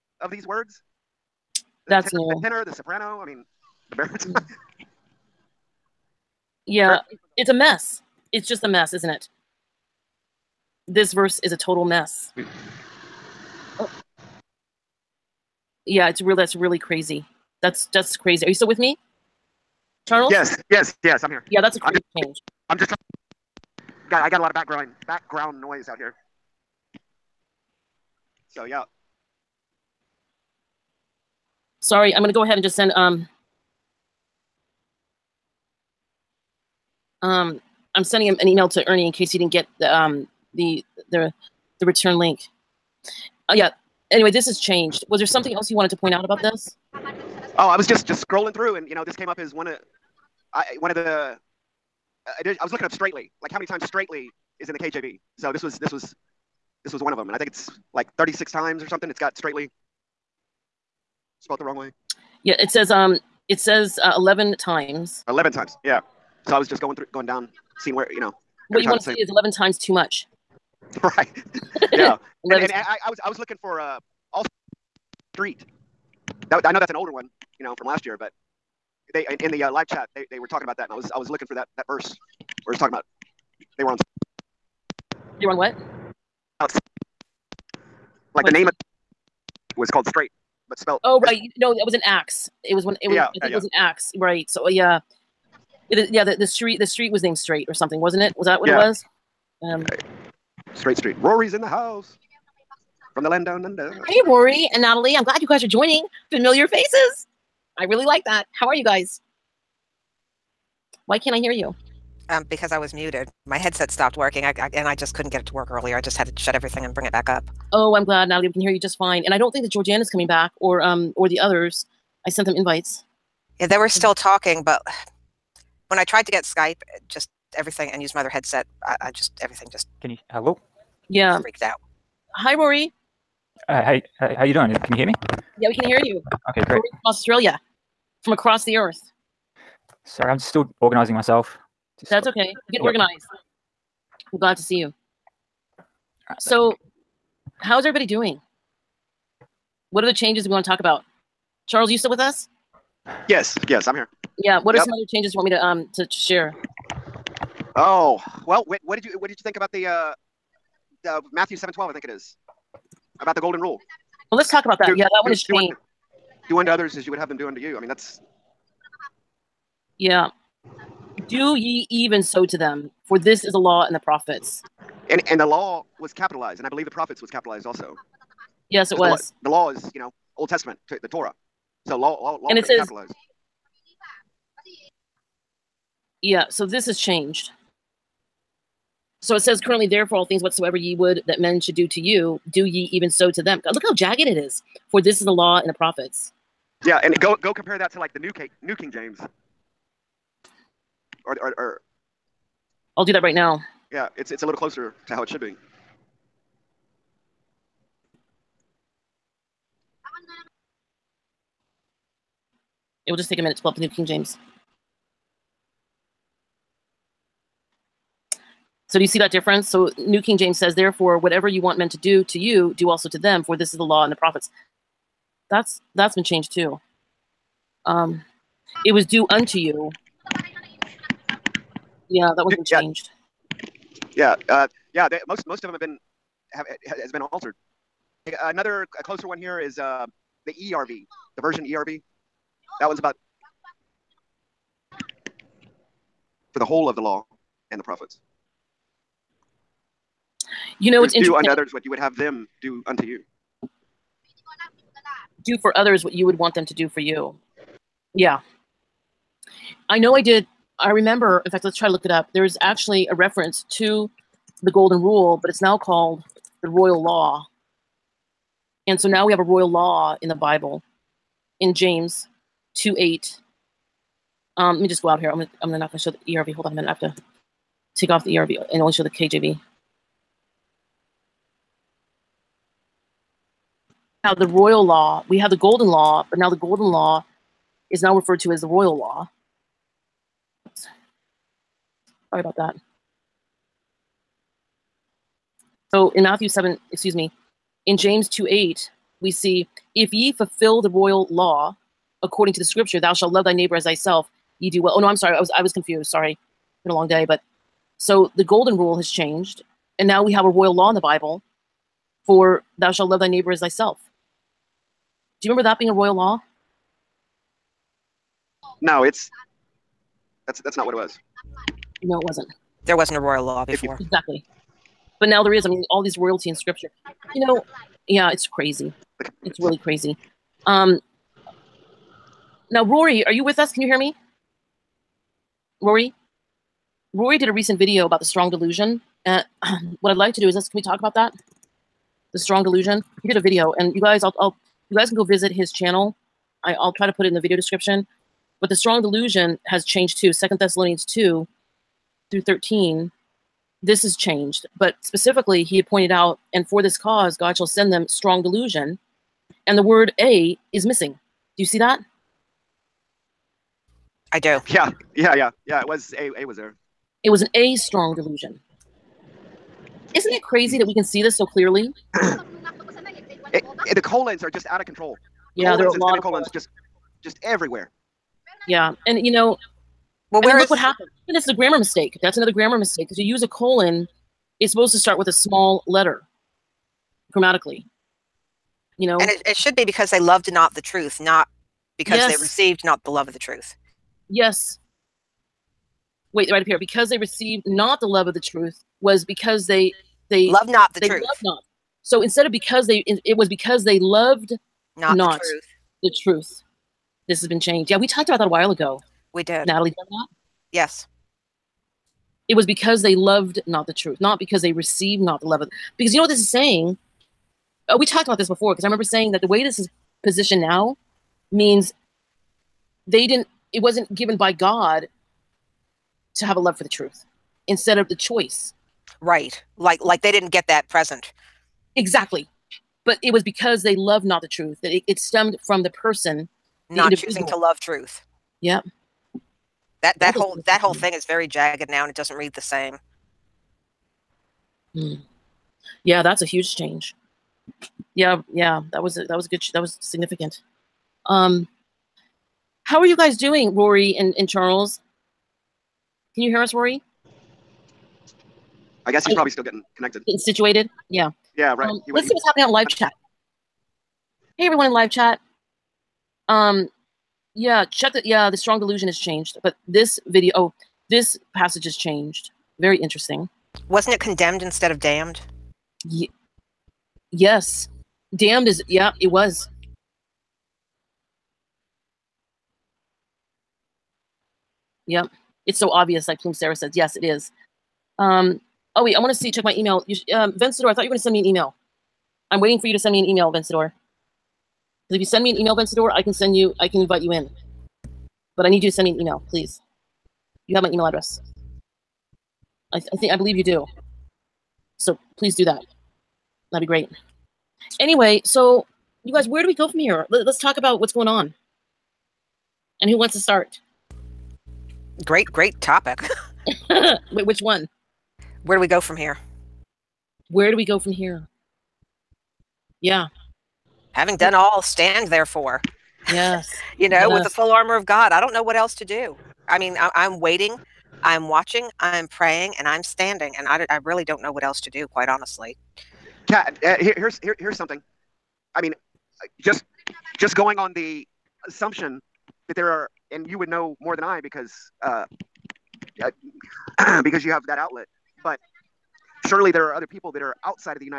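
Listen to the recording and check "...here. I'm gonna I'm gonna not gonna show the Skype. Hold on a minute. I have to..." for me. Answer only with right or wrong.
wrong.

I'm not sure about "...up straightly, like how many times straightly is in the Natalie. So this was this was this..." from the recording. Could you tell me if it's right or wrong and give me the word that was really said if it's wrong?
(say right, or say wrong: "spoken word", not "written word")
wrong: "KJV", not "Natalie".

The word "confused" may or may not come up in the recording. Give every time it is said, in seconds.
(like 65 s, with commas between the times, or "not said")
305 s.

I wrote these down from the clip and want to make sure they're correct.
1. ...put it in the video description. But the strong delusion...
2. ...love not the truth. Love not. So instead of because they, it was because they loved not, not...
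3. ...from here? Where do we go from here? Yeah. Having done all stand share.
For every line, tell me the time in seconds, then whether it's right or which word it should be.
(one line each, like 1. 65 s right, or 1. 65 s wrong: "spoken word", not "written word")
1. 347 s right
2. 400 s right
3. 519 s wrong: "therefore", not "share".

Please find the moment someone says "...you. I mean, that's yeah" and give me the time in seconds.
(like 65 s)
167 s.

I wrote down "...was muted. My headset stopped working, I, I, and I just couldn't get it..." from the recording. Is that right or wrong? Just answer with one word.
right.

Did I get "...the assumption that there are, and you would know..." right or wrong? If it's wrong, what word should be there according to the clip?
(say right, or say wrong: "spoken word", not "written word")
right.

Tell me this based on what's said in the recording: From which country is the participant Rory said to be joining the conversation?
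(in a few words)
Australia.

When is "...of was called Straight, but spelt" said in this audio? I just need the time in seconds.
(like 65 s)
88 s.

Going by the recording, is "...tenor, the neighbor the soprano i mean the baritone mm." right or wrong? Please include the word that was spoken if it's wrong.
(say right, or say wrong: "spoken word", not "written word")
wrong: "tenor", not "neighbor".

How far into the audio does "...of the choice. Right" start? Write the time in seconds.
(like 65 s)
427 s.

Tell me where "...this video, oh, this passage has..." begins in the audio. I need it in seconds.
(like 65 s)
469 s.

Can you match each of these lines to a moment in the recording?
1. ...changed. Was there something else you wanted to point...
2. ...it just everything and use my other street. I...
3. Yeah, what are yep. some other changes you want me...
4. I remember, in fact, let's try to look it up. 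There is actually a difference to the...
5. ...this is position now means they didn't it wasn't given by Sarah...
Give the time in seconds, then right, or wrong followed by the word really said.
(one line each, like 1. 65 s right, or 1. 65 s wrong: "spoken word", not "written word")
1. 44 s right
2. 126 s wrong: "headset", not "street"
3. 154 s right
4. 260 s wrong: "reference", not "difference"
5. 419 s wrong: "God", not "Sarah".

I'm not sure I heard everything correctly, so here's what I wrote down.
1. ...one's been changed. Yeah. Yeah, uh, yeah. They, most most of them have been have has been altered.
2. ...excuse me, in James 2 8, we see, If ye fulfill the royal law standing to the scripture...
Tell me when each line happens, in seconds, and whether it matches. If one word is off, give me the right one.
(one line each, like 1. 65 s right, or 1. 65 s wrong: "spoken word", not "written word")
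1. 232 s right
2. 296 s wrong: "according", not "standing".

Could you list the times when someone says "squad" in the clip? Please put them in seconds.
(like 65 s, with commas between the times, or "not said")
not said.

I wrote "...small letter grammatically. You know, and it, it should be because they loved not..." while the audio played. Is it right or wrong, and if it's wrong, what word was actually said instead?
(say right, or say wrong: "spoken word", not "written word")
right.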